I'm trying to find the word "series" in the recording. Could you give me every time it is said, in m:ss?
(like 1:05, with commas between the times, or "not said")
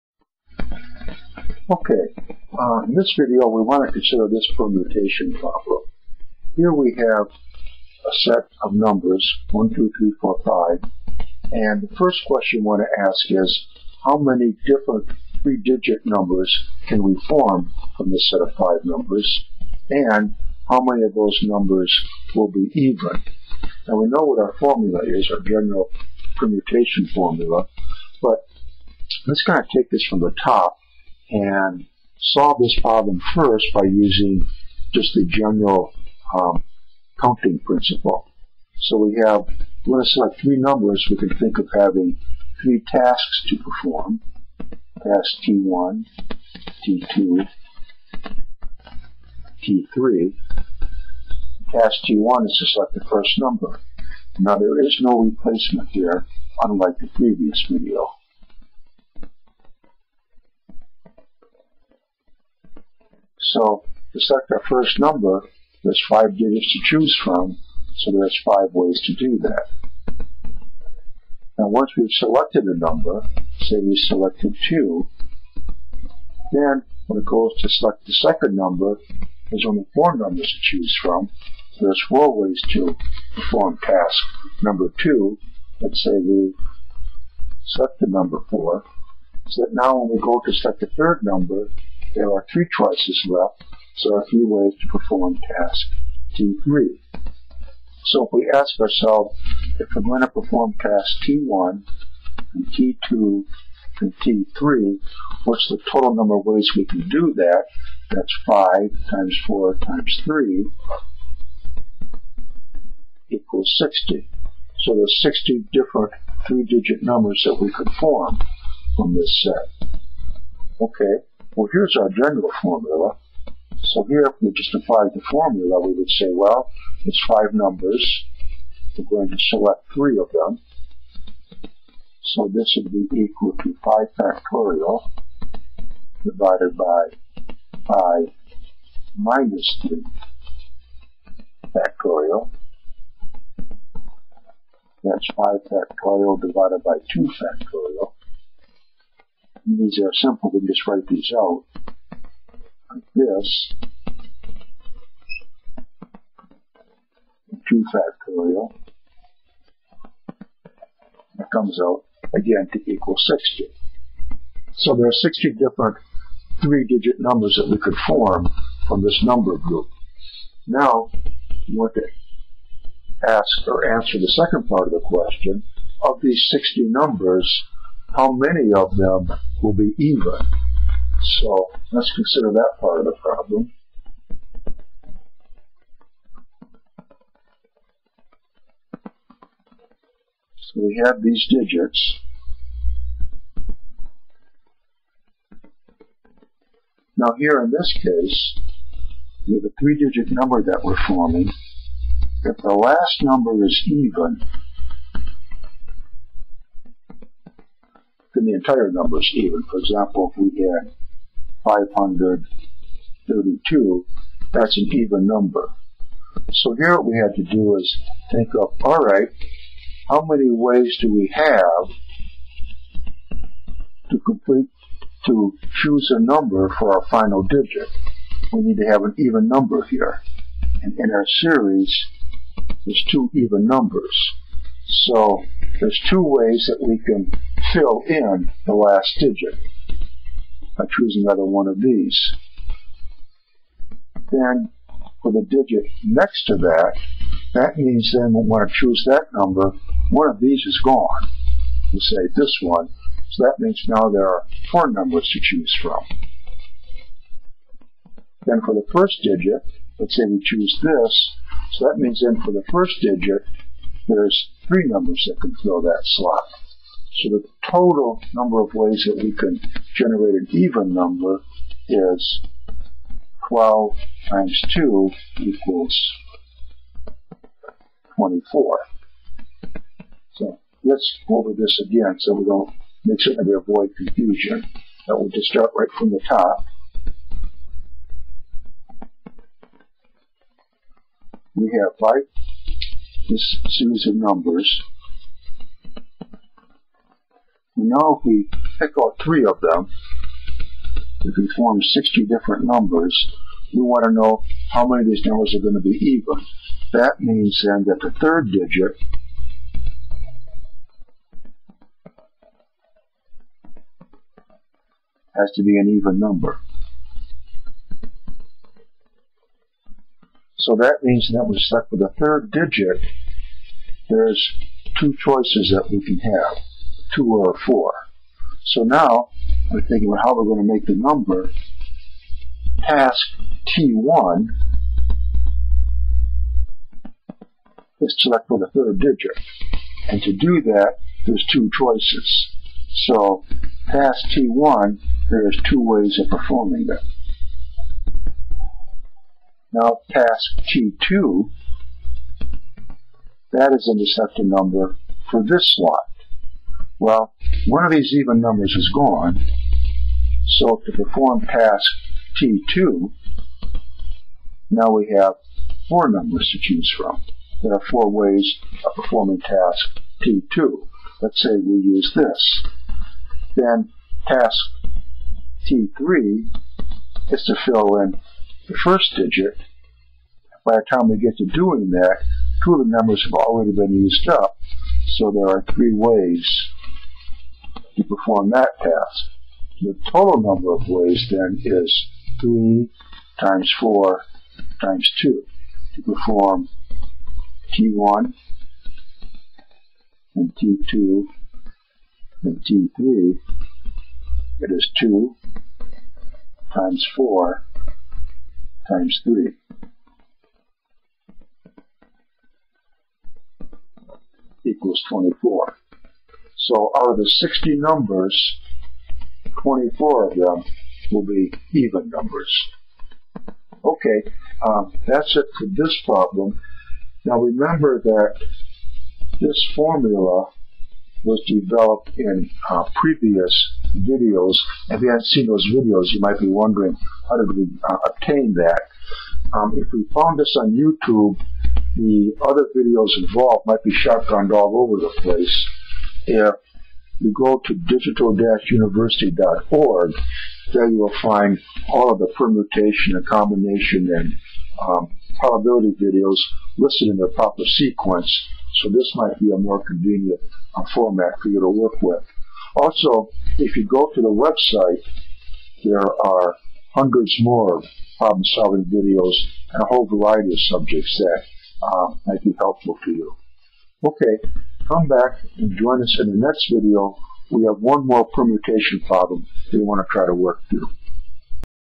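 3:51, 4:53.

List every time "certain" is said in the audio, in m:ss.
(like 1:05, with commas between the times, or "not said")
4:43.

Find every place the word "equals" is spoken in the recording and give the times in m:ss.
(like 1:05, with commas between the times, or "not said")
1:53, 2:13, 2:42, 4:35, 6:54.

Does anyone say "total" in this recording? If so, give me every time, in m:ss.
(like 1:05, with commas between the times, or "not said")
1:45, 4:27, 6:30.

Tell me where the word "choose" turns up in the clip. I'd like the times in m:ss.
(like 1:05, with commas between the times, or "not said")
1:06, 1:20, 3:45, 4:00, 4:08, 4:15, 4:20, 6:06.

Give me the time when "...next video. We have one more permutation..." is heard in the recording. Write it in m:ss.
7:56.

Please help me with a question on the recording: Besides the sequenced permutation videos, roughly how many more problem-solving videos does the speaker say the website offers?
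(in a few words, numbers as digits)
hundreds.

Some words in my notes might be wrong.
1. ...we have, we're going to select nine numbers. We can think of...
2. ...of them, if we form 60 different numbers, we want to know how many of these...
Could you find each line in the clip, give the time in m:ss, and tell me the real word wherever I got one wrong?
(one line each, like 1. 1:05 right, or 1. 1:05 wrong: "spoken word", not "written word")
1. 0:38 wrong: "three", not "nine"
2. 4:59 right.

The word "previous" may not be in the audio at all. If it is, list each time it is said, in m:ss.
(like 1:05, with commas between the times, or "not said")
0:57, 7:12.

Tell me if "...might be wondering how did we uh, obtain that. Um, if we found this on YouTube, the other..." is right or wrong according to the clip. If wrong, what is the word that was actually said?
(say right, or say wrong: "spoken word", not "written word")
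right.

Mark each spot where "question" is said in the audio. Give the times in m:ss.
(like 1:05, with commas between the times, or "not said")
0:12, 2:55.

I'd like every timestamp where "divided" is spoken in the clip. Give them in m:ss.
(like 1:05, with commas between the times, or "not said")
2:16, 2:26.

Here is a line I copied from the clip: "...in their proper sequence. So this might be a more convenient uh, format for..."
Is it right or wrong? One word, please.
right.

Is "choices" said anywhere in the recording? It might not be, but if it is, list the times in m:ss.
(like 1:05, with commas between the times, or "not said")
1:32, 5:25, 5:41.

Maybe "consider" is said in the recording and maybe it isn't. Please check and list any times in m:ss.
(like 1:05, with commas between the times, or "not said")
0:03, 3:02.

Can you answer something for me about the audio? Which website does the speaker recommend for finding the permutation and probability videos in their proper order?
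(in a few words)
digital-university.org.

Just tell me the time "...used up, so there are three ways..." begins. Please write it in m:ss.
6:23.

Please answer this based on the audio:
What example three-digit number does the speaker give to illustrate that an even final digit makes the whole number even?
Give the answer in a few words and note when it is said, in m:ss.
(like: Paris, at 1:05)
532, at 3:31.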